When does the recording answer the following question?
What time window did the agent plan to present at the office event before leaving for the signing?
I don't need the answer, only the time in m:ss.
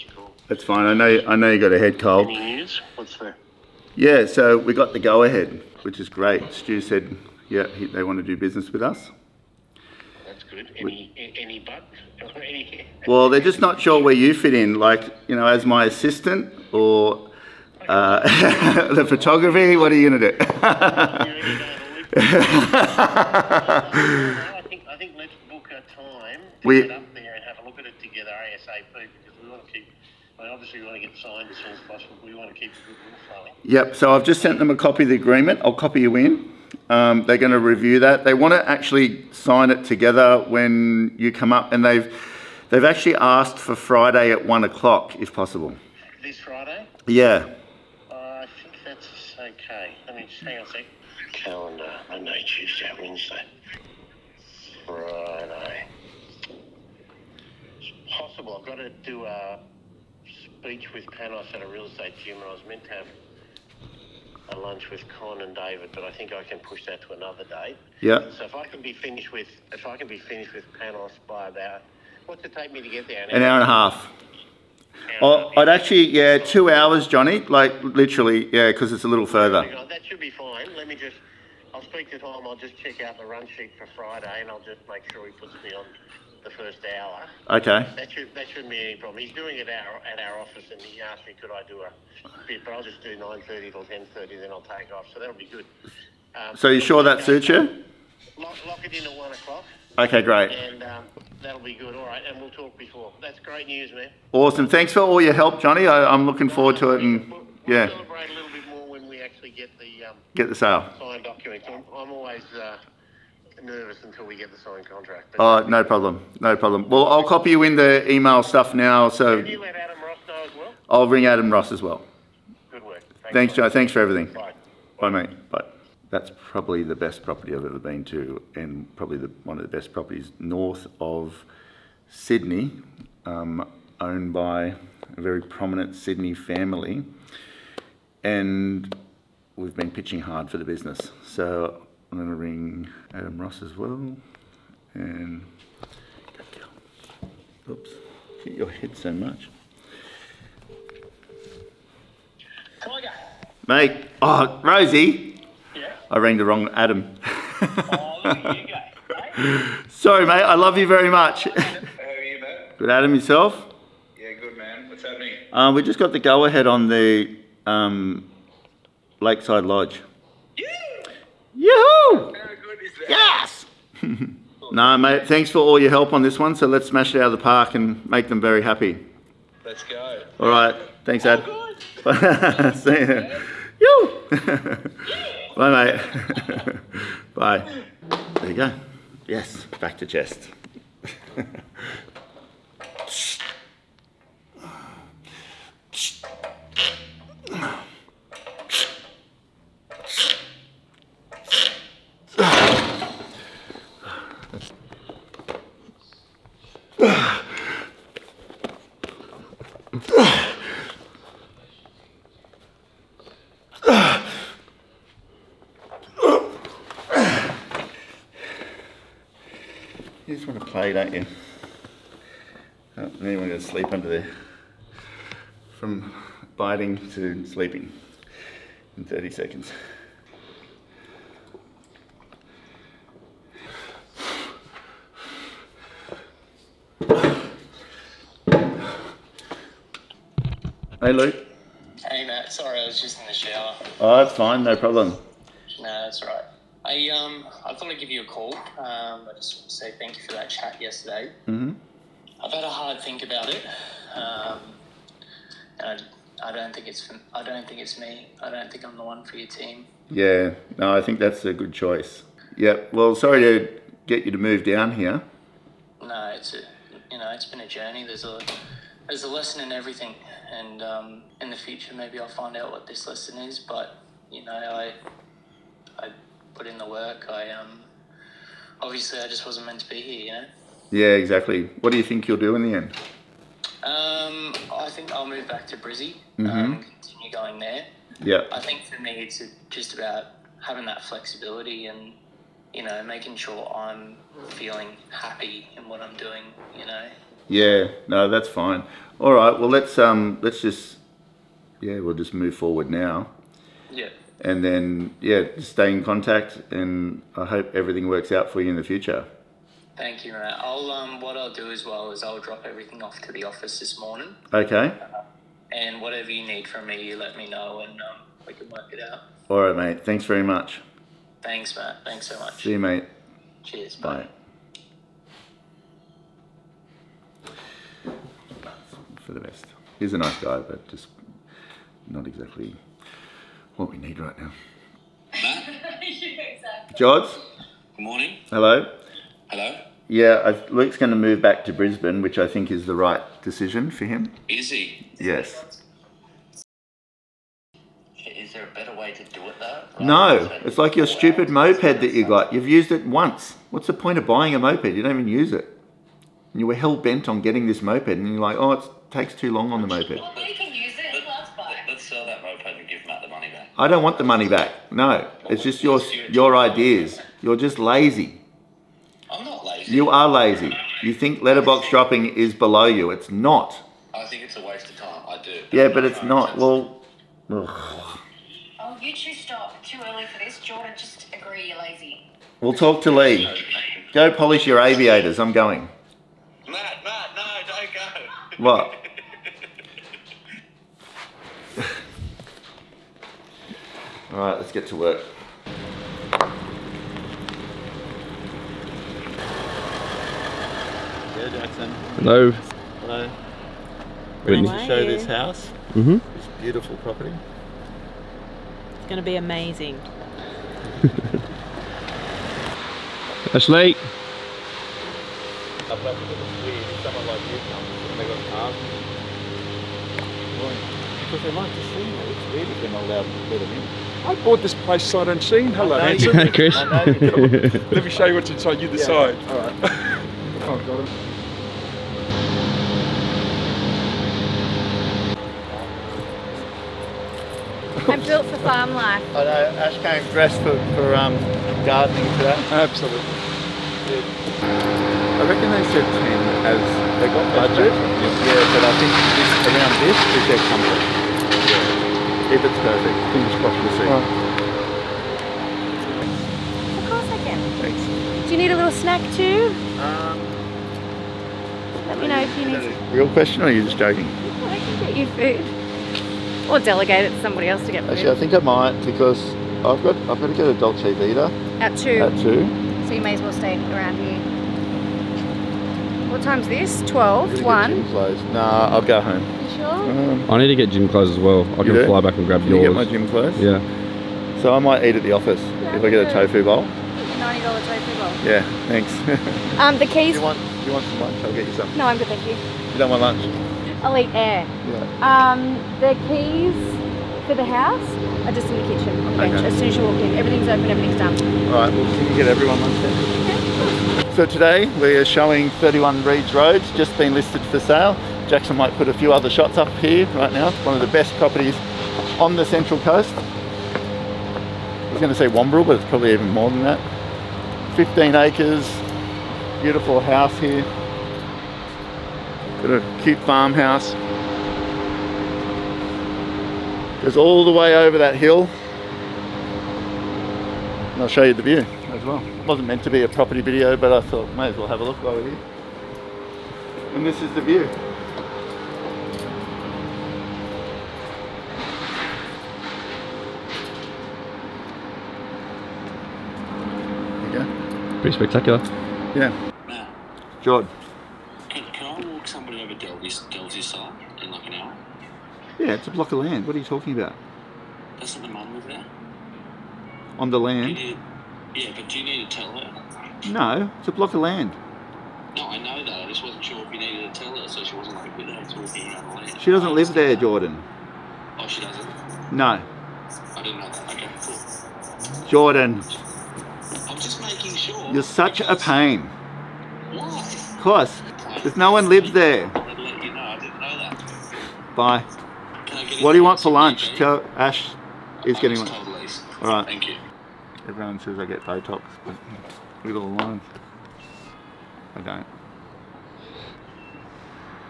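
1:33.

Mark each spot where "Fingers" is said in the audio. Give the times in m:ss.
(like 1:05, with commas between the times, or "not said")
7:33.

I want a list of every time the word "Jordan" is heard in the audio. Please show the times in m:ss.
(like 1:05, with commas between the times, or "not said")
6:20, 9:30, 9:35.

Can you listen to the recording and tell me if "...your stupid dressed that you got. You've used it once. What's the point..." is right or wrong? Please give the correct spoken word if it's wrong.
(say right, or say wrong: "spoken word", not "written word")
wrong: "moped", not "dressed".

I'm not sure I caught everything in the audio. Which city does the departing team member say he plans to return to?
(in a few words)
Brisbane.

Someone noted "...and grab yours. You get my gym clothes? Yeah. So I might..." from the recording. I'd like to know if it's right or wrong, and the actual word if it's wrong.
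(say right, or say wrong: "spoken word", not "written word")
right.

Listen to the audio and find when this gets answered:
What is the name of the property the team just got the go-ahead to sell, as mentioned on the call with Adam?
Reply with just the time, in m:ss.
2:49.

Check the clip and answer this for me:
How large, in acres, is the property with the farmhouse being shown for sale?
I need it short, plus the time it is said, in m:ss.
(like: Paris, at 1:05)
15 acres, at 8:37.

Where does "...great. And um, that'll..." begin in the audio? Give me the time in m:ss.
1:40.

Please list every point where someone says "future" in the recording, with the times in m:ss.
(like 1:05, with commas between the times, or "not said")
4:31, 5:08.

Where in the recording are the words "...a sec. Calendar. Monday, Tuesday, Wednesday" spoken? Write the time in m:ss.
0:50.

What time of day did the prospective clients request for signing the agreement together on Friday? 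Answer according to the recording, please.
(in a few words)
1 o'clock.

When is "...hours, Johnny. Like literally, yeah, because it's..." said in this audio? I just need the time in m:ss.
1:16.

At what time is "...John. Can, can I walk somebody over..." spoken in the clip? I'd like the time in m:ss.
9:10.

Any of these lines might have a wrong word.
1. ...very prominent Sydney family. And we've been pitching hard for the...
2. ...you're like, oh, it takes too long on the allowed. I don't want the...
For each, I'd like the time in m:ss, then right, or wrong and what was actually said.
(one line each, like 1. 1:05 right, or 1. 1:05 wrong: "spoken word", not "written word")
1. 2:15 right
2. 5:58 wrong: "moped", not "allowed".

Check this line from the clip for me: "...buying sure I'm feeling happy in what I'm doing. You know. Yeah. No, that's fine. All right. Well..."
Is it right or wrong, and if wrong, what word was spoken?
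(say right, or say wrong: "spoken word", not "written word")
wrong: "making", not "buying".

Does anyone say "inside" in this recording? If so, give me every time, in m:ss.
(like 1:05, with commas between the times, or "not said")
7:08.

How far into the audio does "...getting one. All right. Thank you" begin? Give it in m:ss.
9:48.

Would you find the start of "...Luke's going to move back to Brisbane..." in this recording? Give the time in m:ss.
5:40.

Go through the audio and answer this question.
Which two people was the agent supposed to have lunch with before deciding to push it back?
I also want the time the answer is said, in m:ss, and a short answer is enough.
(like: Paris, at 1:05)
Con and David, at 1:05.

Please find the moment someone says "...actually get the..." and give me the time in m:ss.
1:49.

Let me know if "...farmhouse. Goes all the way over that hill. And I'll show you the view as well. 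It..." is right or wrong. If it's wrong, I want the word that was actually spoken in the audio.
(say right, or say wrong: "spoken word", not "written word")
right.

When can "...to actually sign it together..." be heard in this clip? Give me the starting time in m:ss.
0:38.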